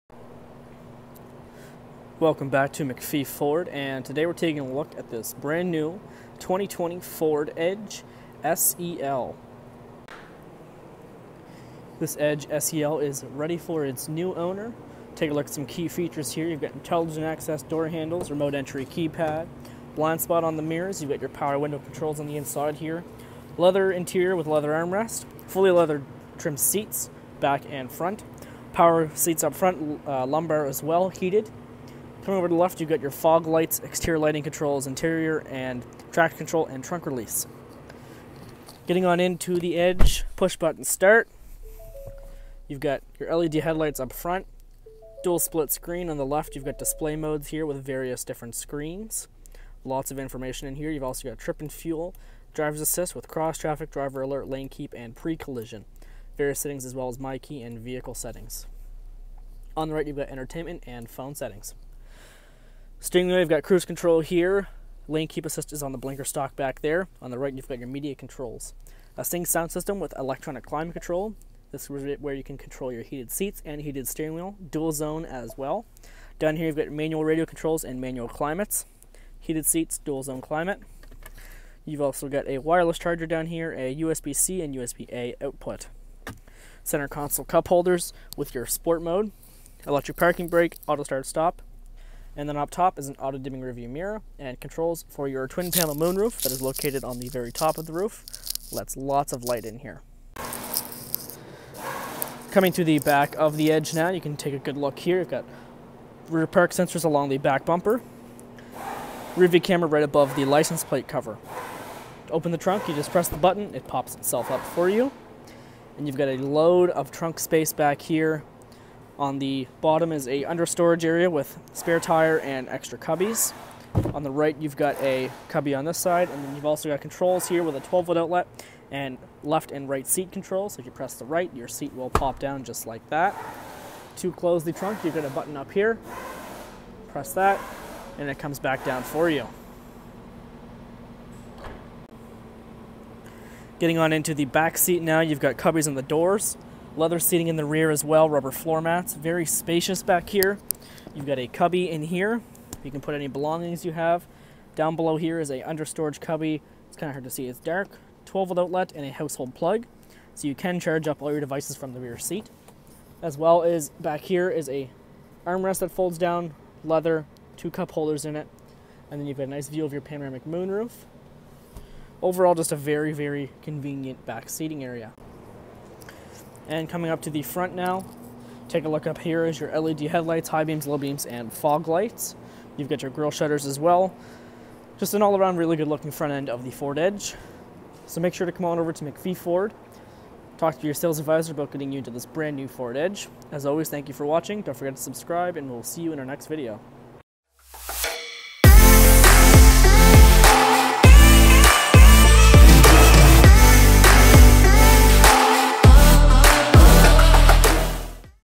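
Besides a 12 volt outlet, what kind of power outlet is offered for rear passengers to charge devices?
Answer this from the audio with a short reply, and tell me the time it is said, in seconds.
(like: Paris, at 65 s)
Household plug, at 159 s.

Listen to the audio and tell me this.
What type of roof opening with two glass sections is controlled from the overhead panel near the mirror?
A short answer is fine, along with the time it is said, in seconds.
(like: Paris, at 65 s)
Twin panel moonroof, at 95 s.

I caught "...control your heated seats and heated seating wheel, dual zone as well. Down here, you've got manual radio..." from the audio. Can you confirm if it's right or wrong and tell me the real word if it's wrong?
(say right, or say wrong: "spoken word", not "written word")
wrong: "steering", not "seating".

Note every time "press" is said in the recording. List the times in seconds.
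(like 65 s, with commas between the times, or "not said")
113 s, 130 s, 137 s.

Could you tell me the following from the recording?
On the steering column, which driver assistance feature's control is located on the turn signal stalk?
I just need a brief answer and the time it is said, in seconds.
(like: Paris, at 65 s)
Lane keep assist, at 65 s.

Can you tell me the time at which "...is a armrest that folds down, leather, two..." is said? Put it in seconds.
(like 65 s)
164 s.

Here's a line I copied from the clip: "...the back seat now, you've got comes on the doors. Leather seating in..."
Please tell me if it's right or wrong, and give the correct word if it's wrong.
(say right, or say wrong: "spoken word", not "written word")
wrong: "cubbies", not "comes".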